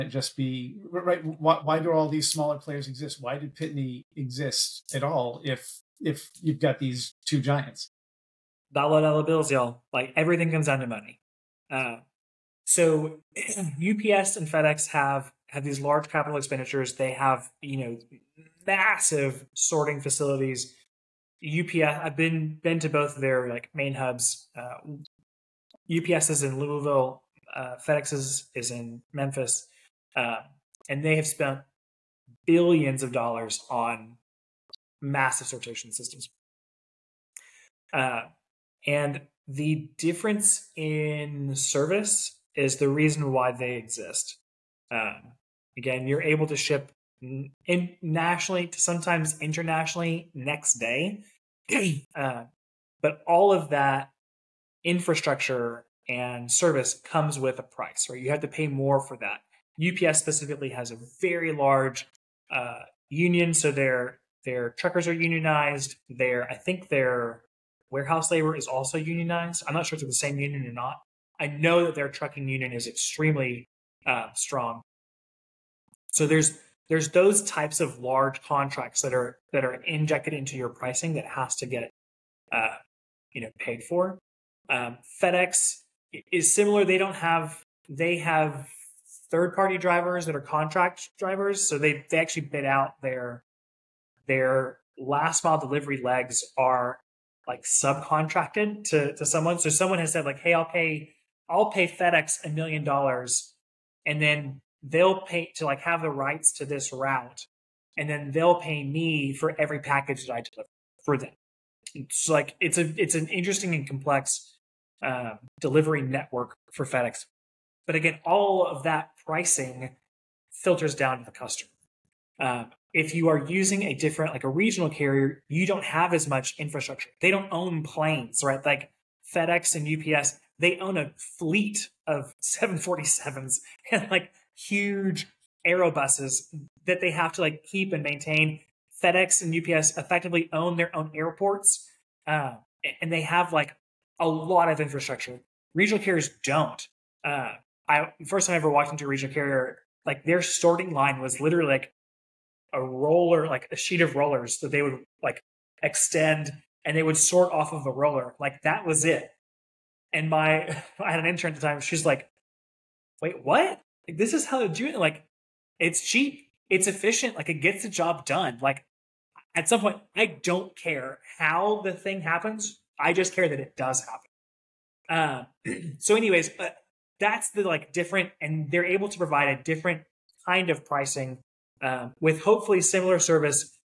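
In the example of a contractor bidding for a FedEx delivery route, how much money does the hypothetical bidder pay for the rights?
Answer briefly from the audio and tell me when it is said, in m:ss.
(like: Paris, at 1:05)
$1 million, at 1:42.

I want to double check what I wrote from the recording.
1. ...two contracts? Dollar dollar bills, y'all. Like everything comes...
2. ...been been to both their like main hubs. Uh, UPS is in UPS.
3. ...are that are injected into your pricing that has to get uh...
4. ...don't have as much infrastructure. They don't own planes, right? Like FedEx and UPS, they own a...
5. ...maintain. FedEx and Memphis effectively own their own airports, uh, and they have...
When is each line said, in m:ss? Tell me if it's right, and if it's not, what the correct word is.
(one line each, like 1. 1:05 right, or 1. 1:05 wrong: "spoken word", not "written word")
1. 0:07 wrong: "giants", not "contracts"
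2. 0:22 wrong: "Louisville", not "UPS"
3. 1:19 right
4. 2:05 right
5. 2:18 wrong: "UPS", not "Memphis".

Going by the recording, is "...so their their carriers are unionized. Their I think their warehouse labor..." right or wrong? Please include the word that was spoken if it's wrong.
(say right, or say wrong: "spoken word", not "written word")
wrong: "truckers", not "carriers".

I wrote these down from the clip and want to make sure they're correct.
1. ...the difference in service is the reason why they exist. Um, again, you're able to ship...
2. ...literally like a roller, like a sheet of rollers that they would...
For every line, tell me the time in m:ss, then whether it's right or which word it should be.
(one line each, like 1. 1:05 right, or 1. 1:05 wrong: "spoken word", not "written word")
1. 0:39 right
2. 2:31 right.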